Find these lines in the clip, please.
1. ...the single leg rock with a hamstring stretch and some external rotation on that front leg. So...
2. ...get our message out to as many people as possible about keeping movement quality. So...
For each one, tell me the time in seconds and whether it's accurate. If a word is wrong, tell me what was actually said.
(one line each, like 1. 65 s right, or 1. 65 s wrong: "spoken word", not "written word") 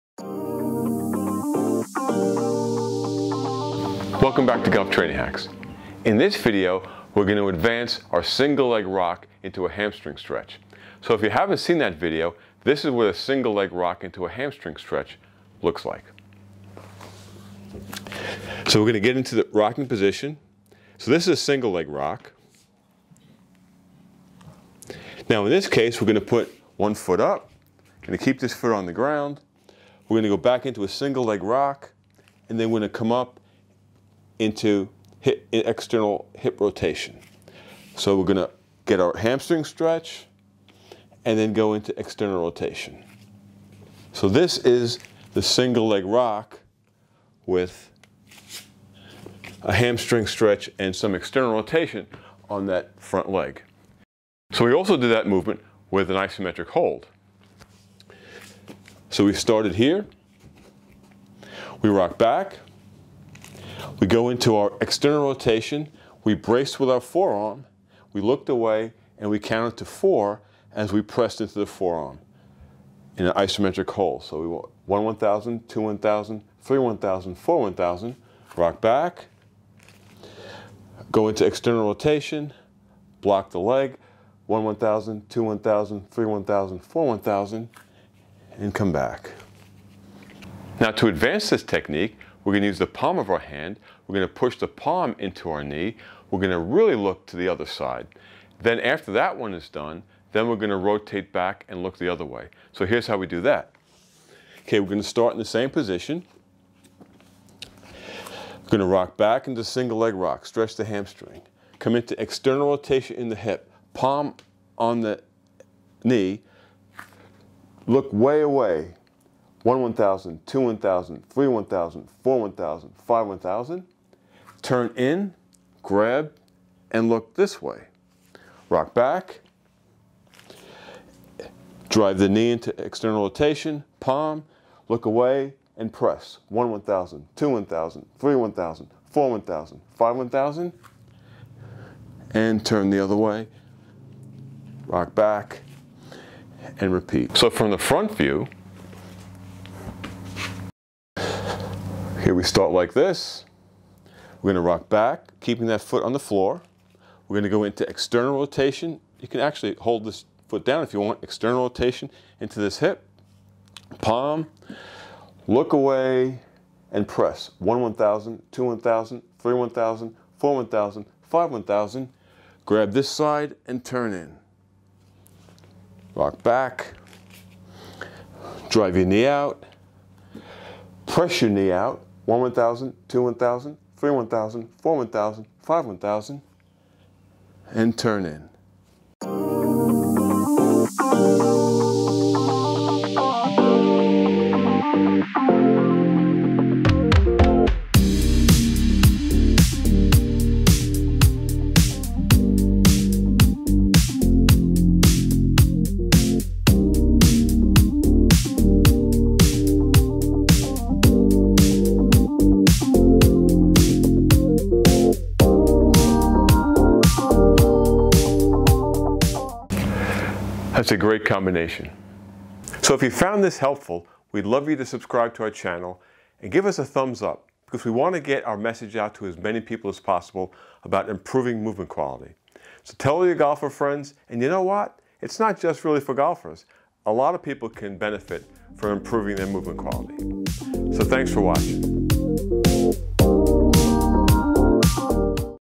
1. 45 s right
2. 228 s wrong: "improving", not "keeping".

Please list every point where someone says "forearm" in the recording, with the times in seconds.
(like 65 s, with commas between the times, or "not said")
66 s, 71 s.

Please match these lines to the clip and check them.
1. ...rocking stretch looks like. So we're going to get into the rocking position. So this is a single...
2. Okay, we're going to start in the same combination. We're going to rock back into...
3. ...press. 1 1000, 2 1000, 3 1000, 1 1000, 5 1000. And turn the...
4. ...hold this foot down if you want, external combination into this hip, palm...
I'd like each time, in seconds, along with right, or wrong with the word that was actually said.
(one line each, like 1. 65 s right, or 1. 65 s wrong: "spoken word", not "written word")
1. 14 s wrong: "hamstring", not "rocking"
2. 104 s wrong: "position", not "combination"
3. 135 s wrong: "4", not "1"
4. 159 s wrong: "rotation", not "combination".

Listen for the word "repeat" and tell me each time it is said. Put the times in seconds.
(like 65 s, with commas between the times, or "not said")
146 s.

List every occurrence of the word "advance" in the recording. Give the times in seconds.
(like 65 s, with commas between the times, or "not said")
7 s, 91 s.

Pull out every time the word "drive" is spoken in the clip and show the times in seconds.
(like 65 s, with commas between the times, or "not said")
131 s, 178 s.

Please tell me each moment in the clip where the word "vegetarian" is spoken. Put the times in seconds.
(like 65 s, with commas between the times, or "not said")
not said.